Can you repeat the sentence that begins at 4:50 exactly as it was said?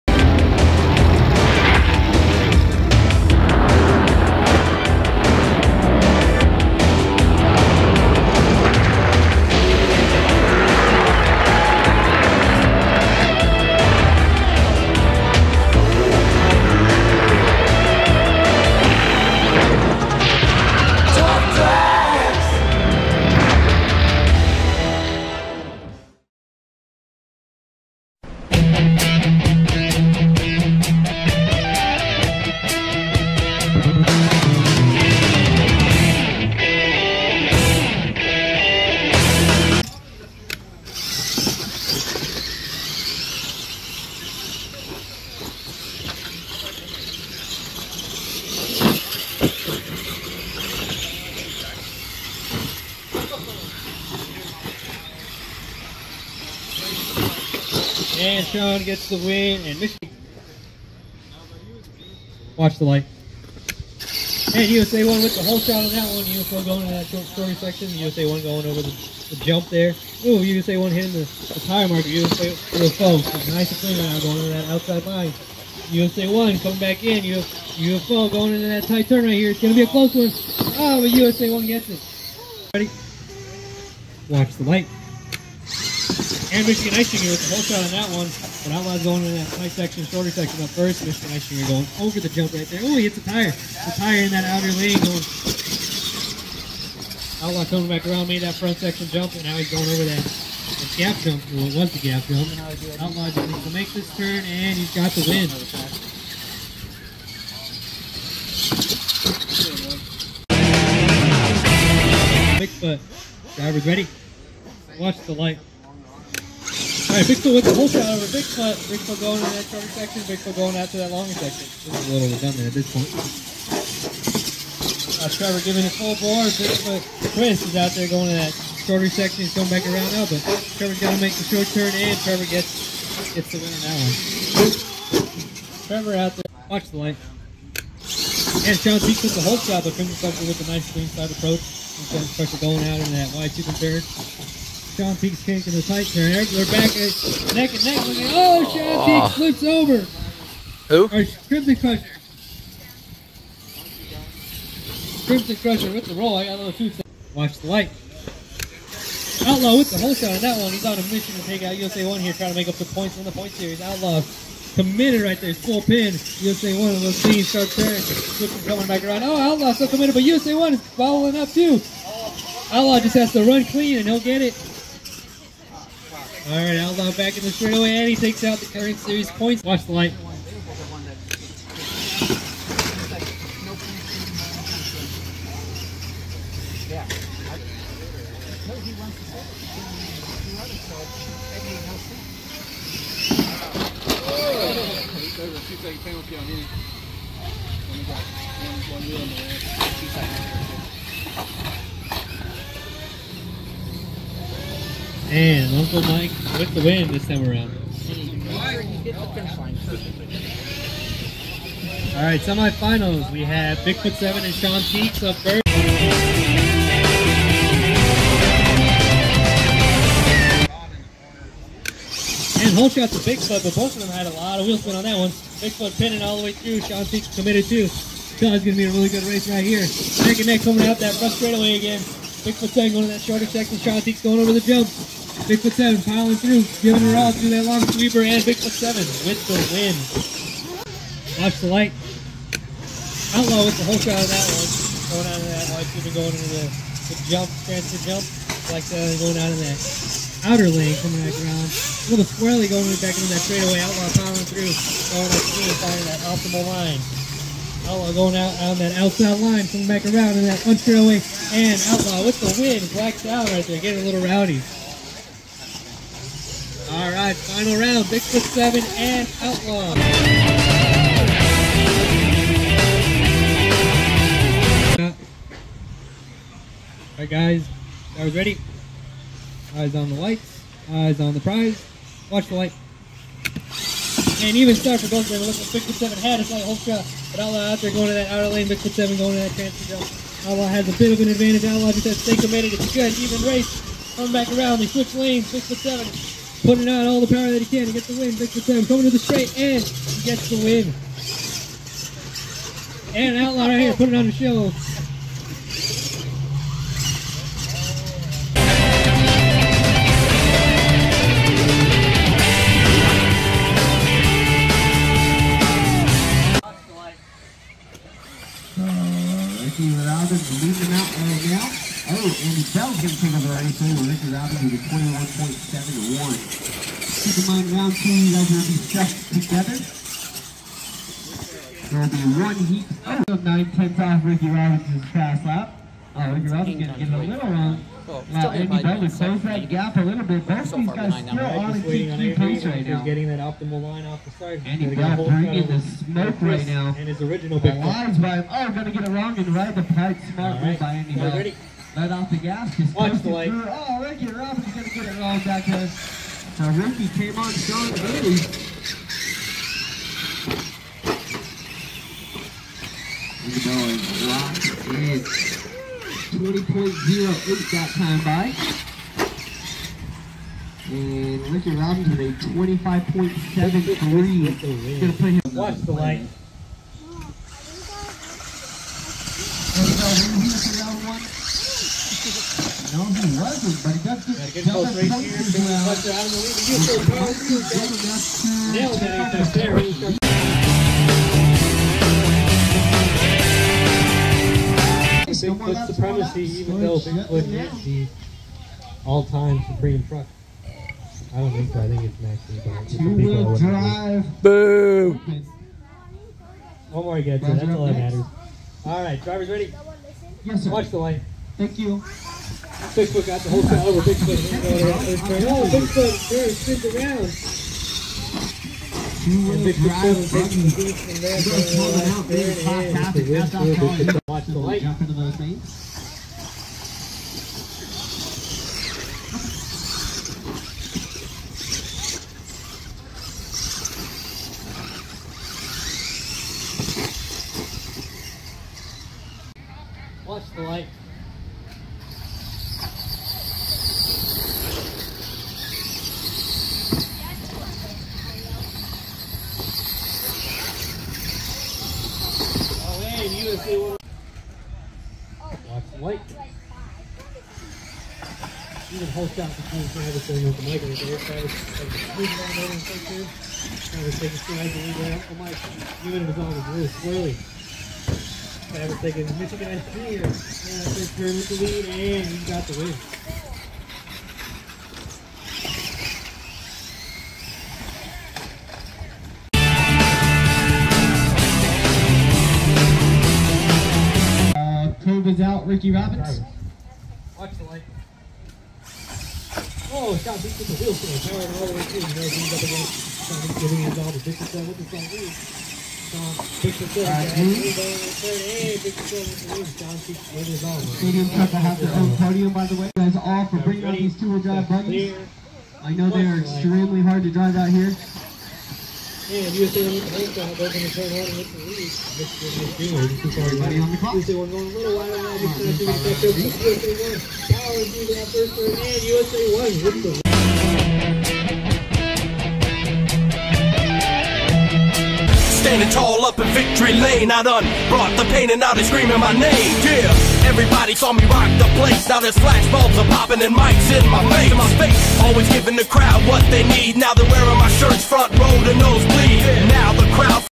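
Outlaw has a bit of an advantage.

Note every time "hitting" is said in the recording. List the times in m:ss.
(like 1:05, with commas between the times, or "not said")
1:10.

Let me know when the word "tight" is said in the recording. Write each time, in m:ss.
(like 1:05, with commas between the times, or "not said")
1:18, 2:25.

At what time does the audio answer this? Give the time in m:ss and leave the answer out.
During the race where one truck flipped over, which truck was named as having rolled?
2:35.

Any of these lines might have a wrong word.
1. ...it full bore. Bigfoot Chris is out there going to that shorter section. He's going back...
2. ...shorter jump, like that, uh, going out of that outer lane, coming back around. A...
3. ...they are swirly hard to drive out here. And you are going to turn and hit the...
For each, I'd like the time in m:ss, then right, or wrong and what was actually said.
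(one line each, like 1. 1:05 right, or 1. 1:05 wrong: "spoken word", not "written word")
1. 2:05 right
2. 4:07 wrong: "transfer", not "shorter"
3. 8:26 wrong: "extremely", not "swirly".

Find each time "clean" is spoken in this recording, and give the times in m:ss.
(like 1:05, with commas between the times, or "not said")
1:13, 2:20, 2:53.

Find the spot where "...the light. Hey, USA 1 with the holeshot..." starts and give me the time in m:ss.
1:02.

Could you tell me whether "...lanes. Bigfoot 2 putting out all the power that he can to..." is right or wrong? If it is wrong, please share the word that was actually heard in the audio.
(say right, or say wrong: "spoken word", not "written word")
wrong: "7", not "2".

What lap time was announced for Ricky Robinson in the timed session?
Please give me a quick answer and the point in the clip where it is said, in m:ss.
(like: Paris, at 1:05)
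25.73, at 6:12.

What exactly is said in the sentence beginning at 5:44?
Andy Bell bringing the smoke right now.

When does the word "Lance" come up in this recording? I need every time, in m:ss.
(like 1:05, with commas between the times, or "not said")
not said.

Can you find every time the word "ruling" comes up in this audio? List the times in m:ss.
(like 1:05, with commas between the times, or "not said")
not said.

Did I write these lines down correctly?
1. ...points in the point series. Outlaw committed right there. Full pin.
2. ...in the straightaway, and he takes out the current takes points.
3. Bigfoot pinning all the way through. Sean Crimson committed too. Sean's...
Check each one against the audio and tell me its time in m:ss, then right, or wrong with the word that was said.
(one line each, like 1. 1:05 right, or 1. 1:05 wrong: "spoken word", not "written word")
1. 2:42 right
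2. 2:57 wrong: "series", not "takes"
3. 3:45 wrong: "Peaks", not "Crimson".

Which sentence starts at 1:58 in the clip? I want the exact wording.
Bigfoot going to that shorter section.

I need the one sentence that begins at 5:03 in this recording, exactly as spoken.
And Outlaw right here putting on the show.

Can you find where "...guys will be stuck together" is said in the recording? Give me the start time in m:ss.
5:28.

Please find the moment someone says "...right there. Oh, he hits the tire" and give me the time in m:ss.
1:32.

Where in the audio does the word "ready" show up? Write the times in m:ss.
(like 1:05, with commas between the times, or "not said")
1:22, 1:53, 4:38, 5:51, 6:49.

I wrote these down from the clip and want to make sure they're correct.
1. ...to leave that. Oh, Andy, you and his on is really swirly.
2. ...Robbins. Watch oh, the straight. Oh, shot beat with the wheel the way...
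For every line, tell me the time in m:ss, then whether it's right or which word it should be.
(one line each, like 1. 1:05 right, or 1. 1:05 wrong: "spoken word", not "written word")
1. 7:44 wrong: "Mike", not "Andy"
2. 8:05 wrong: "light", not "straight".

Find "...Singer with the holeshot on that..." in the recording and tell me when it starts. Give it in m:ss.
1:27.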